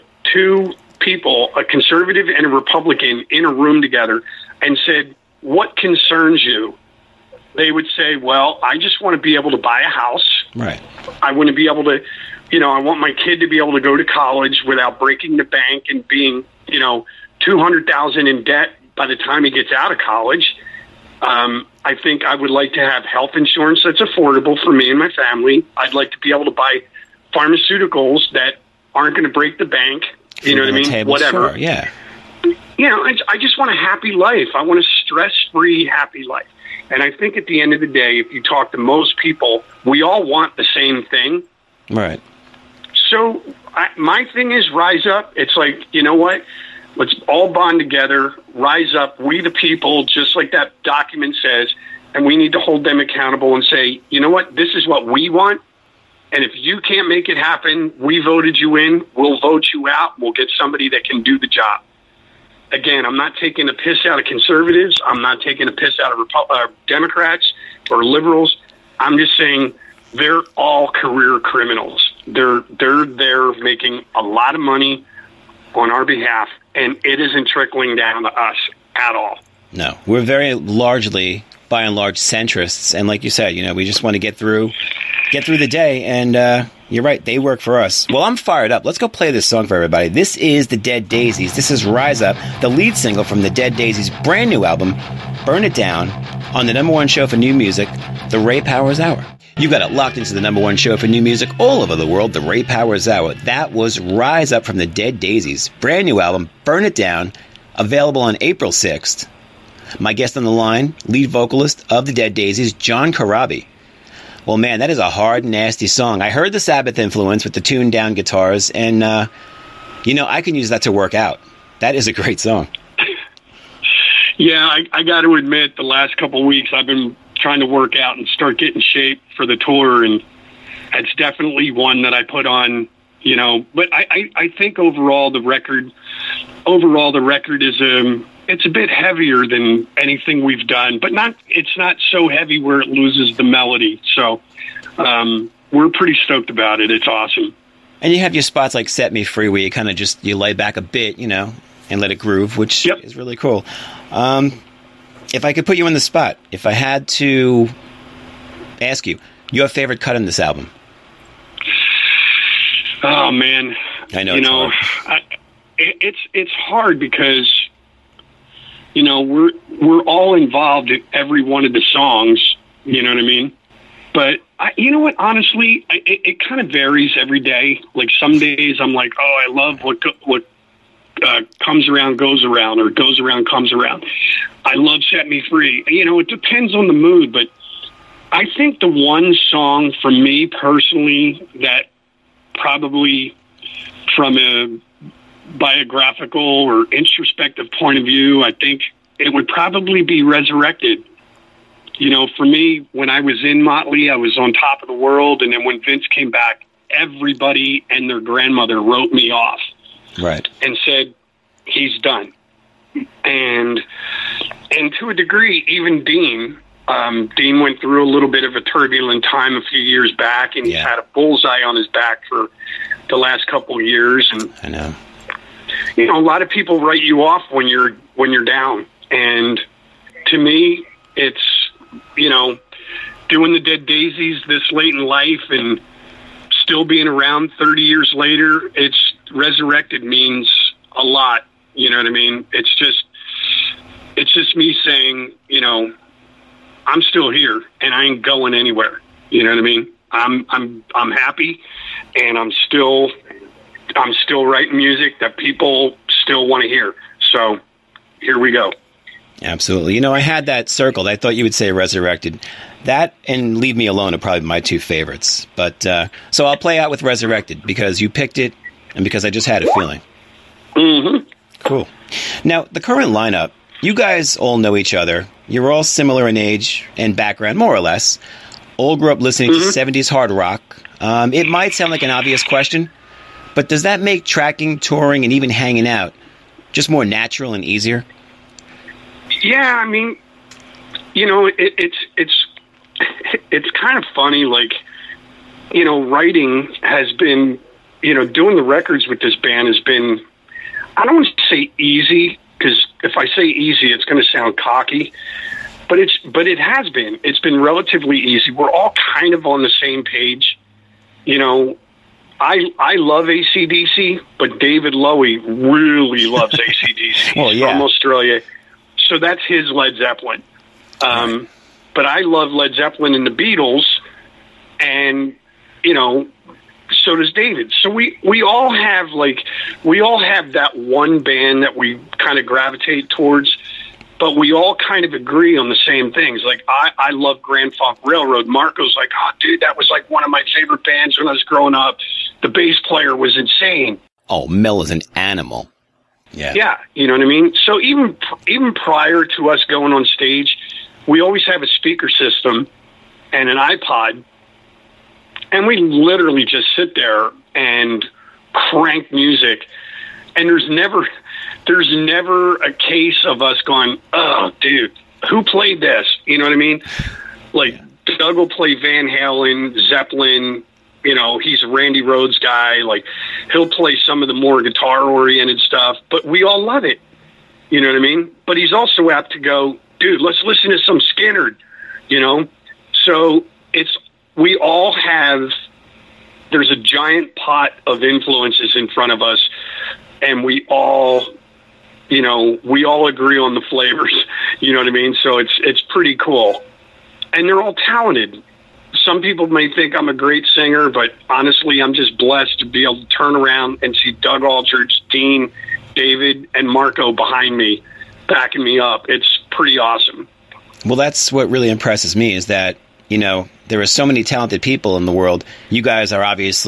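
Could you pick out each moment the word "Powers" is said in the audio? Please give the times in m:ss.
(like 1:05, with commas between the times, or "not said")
1:38, 1:42.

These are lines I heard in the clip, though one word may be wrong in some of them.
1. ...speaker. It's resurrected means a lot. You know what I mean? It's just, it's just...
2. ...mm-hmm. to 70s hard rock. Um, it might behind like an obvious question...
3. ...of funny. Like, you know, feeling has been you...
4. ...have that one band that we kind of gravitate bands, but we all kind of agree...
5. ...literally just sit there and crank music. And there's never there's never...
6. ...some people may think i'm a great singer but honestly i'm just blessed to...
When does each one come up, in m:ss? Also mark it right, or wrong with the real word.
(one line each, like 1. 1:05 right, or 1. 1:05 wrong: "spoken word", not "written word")
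1. 3:58 wrong: "later", not "speaker"
2. 4:39 wrong: "sound", not "behind"
3. 4:53 wrong: "writing", not "feeling"
4. 5:30 wrong: "towards", not "bands"
5. 5:55 right
6. 6:39 right.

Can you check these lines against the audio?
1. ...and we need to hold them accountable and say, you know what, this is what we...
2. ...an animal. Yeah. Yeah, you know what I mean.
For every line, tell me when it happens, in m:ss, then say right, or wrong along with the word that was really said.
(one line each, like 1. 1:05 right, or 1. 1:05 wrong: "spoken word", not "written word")
1. 0:52 right
2. 5:44 right.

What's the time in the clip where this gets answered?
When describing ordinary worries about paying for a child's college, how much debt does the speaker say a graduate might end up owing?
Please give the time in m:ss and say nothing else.
0:17.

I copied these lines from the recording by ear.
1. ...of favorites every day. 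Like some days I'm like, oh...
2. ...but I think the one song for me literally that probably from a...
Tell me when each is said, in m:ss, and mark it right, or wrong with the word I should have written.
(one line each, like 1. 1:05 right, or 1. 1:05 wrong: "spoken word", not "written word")
1. 2:56 wrong: "varies", not "favorites"
2. 3:07 wrong: "personally", not "literally".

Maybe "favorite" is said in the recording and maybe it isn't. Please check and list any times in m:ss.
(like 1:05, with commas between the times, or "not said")
2:39, 4:24, 5:40.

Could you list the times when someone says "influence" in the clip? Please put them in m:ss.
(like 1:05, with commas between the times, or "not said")
1:56, 6:28.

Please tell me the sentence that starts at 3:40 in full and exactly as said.
he had a bullseye on his back for the last couple of years.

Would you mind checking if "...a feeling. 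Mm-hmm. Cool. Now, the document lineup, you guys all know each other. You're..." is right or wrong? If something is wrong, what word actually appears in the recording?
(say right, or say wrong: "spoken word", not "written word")
wrong: "current", not "document".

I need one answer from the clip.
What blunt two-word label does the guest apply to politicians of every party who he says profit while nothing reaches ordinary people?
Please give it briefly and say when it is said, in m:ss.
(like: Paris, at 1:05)
career criminals, at 1:10.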